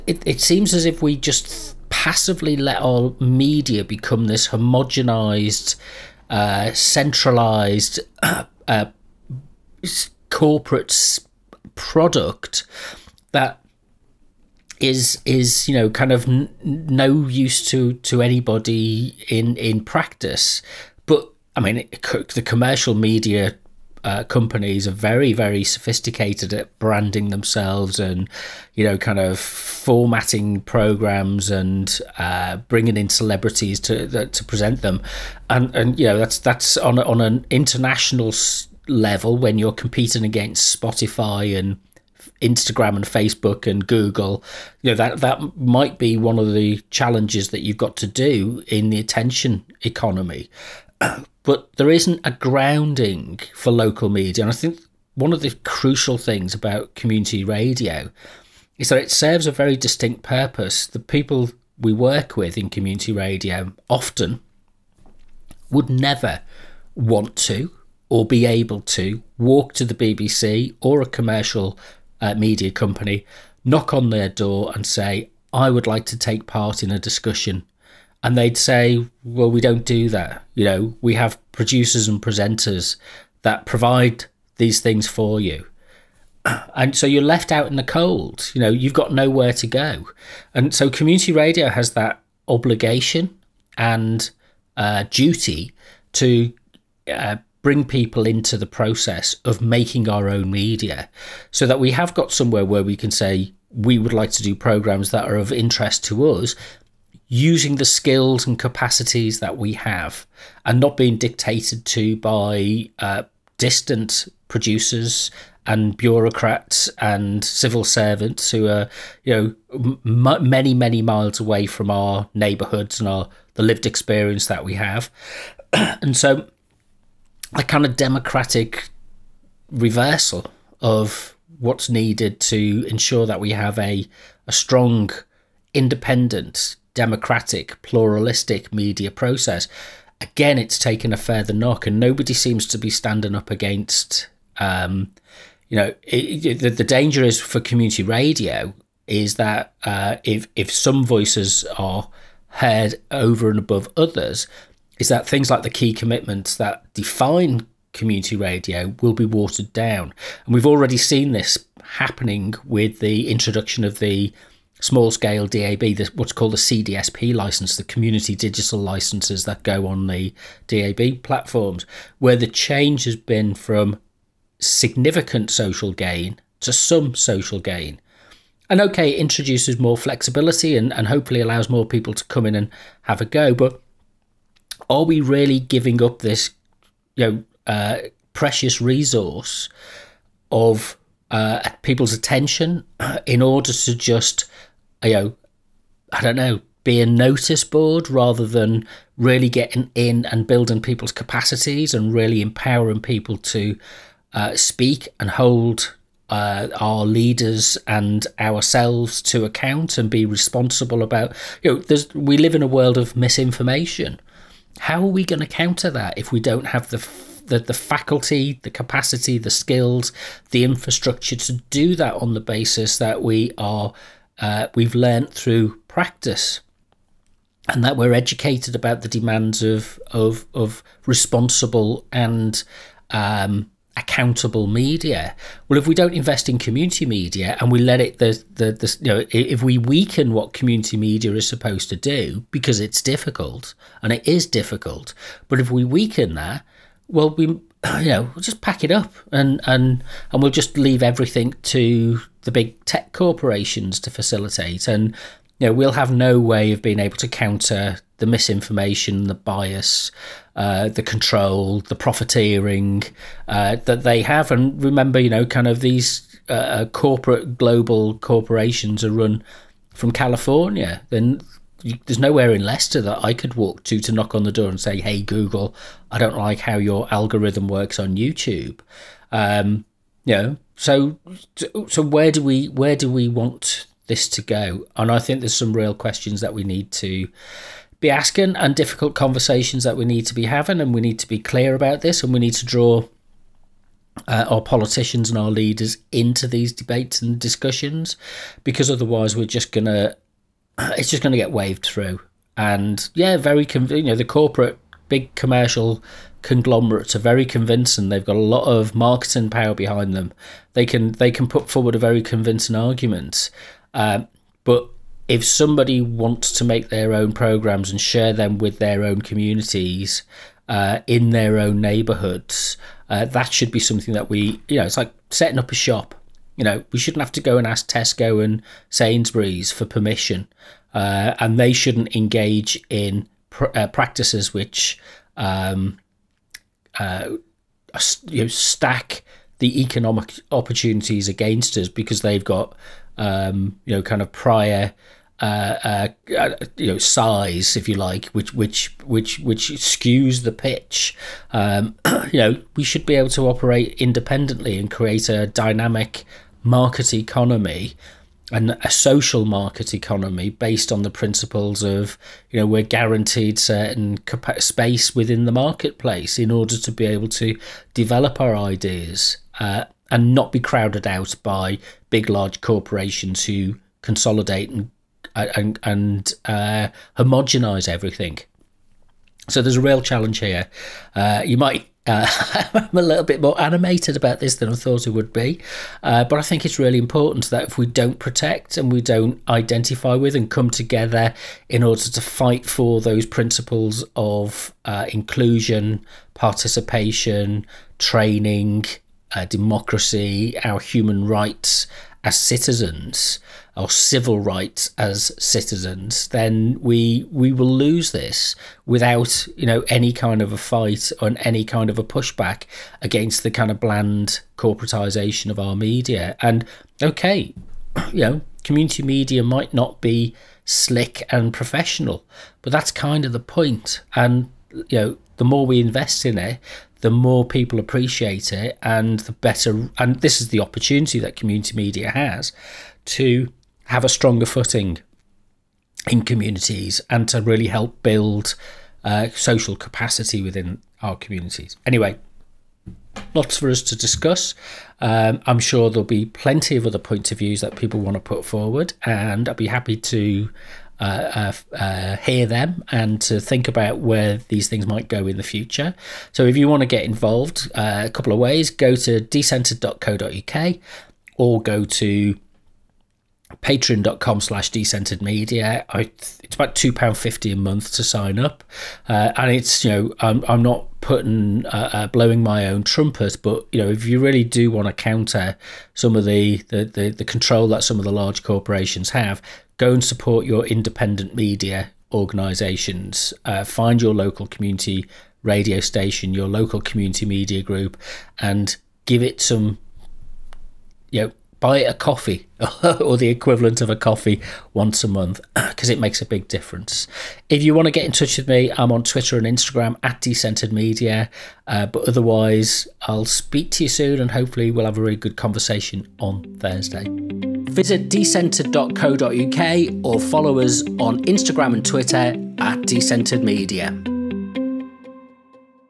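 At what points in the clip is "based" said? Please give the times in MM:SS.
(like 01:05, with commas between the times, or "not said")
06:00.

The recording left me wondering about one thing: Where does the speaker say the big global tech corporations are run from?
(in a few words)
California.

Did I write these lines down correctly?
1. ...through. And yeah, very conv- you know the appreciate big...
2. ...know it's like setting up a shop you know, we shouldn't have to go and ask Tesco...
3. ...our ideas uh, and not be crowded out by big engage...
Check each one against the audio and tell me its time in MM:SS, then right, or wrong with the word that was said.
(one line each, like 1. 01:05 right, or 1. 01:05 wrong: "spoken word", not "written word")
1. 05:01 wrong: "corporate", not "appreciate"
2. 05:24 right
3. 06:08 wrong: "large", not "engage".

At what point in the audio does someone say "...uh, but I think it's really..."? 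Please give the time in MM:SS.
06:26.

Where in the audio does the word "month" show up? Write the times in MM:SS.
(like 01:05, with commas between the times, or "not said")
07:47, 08:15.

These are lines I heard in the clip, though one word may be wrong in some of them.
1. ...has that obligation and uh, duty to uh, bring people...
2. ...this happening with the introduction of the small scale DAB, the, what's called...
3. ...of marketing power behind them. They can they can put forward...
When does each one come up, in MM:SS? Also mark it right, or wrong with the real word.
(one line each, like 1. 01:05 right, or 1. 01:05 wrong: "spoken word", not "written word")
1. 01:31 right
2. 02:41 right
3. 05:08 right.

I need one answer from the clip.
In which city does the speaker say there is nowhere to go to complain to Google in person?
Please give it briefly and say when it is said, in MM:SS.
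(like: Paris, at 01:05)
Leicester, at 04:32.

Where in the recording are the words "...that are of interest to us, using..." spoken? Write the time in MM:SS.
01:45.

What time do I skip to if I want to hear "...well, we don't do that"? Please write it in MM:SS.
01:19.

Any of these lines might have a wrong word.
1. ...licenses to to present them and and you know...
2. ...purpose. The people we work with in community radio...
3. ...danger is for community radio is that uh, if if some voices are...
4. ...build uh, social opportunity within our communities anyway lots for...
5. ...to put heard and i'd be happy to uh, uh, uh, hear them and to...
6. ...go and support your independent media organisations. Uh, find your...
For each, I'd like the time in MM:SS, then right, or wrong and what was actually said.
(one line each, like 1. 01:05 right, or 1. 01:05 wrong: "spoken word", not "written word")
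1. 00:33 wrong: "celebrities", not "licenses"
2. 01:00 right
3. 02:26 right
4. 07:18 wrong: "capacity", not "opportunity"
5. 07:28 wrong: "forward", not "heard"
6. 07:59 right.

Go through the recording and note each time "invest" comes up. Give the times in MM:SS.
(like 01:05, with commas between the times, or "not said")
03:56, 07:05.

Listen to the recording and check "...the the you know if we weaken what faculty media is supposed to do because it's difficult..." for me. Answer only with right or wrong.
wrong.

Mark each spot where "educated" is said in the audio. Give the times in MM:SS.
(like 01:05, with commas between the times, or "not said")
03:48.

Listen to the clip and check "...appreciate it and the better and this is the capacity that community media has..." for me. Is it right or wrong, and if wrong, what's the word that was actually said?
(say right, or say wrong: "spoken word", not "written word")
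wrong: "opportunity", not "capacity".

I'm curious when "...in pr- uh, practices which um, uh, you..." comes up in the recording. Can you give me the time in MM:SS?
05:32.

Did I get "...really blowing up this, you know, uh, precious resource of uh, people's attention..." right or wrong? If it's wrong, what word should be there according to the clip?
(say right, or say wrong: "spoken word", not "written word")
wrong: "giving", not "blowing".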